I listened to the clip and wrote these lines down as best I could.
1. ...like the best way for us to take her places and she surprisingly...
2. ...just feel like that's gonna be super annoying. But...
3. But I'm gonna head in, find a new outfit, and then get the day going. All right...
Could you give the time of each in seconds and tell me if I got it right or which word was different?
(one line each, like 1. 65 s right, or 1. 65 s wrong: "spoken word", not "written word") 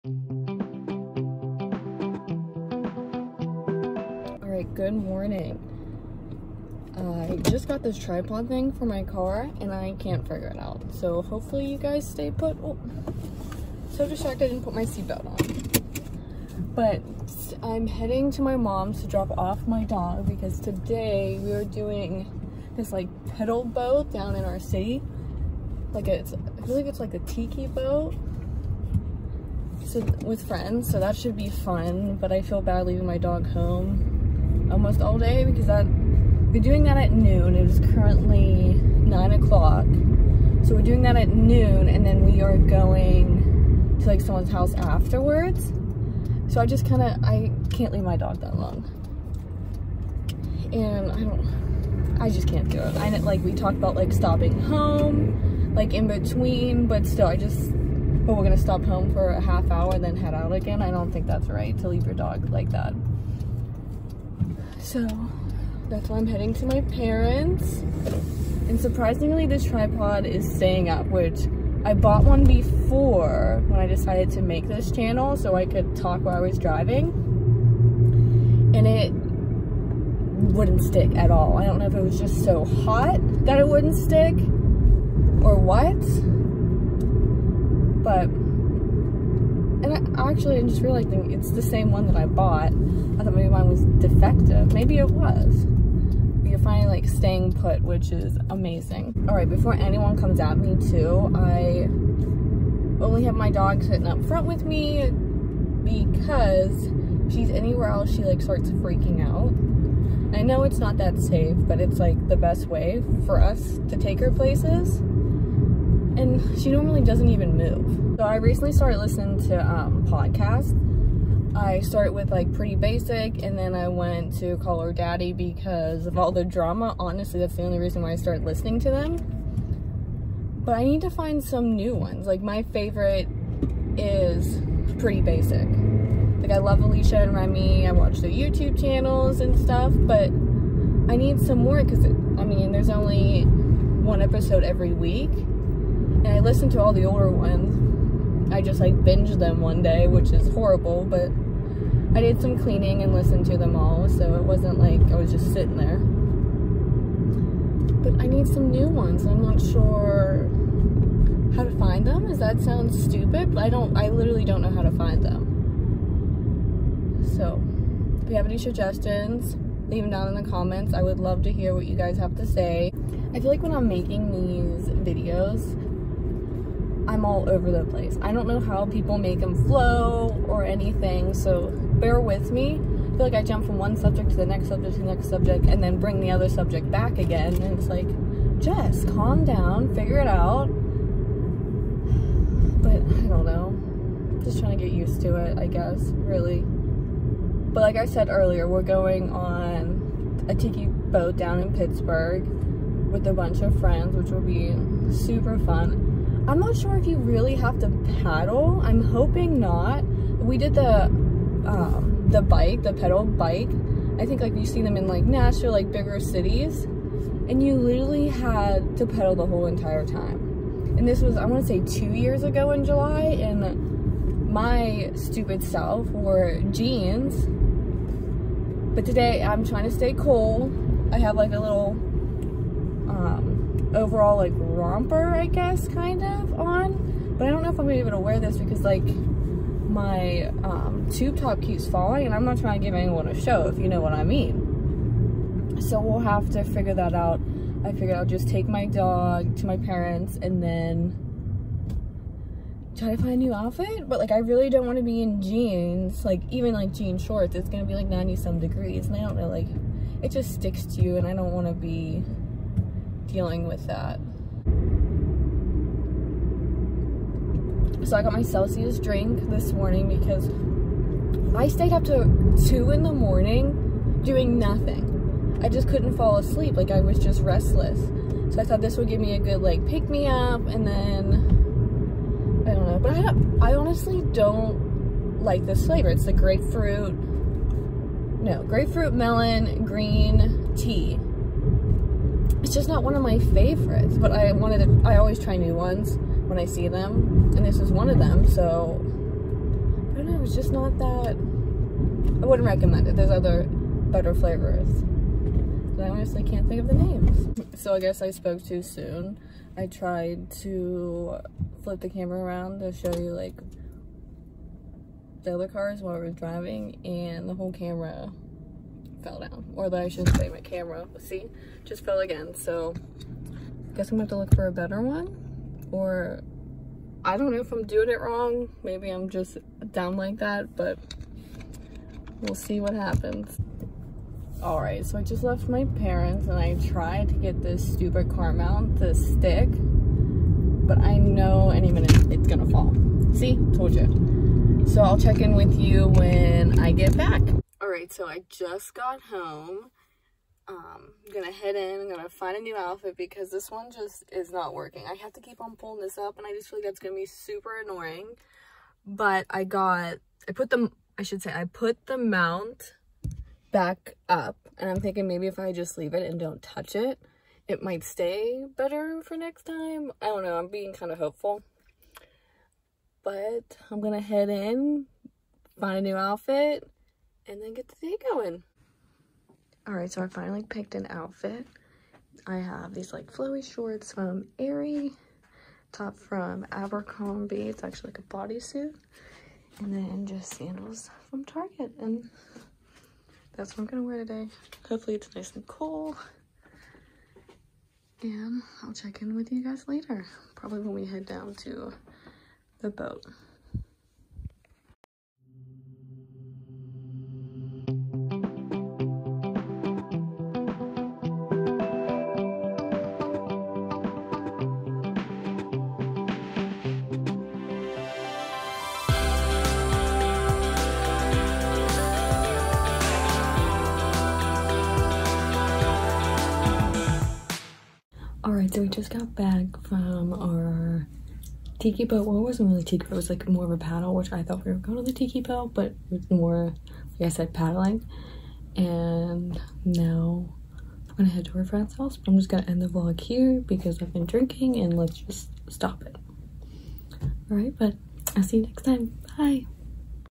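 1. 111 s wrong: "normally", not "surprisingly"
2. 356 s right
3. 373 s right.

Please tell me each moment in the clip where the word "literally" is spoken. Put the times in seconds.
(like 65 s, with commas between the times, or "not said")
164 s, 217 s.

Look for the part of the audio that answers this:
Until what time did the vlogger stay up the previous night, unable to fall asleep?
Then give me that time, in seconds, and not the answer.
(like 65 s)
272 s.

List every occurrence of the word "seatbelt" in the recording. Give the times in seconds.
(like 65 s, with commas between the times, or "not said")
14 s.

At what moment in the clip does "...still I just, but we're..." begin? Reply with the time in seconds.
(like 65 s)
57 s.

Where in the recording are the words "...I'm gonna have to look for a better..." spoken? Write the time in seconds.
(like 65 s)
324 s.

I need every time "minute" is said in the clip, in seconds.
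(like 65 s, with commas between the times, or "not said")
341 s.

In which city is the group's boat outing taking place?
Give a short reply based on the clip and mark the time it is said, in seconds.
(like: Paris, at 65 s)
Pittsburgh, at 201 s.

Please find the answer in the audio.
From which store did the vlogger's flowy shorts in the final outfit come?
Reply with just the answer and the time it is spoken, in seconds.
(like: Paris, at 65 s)
Aerie, at 384 s.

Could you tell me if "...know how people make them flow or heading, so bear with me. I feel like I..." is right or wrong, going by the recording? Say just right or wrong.
wrong.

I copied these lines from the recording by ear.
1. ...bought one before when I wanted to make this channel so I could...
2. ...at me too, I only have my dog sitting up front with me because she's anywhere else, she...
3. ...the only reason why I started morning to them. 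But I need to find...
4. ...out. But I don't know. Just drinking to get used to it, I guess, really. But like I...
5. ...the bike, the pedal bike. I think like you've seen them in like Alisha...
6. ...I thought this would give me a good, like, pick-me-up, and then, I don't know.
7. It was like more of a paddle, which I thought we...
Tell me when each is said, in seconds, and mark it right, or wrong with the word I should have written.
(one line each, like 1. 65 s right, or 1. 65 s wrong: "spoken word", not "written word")
1. 71 s wrong: "decided", not "wanted"
2. 100 s right
3. 127 s wrong: "listening", not "morning"
4. 190 s wrong: "trying", not "drinking"
5. 212 s wrong: "Nashville", not "Alisha"
6. 278 s right
7. 433 s right.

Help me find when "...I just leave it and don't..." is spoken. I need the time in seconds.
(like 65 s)
365 s.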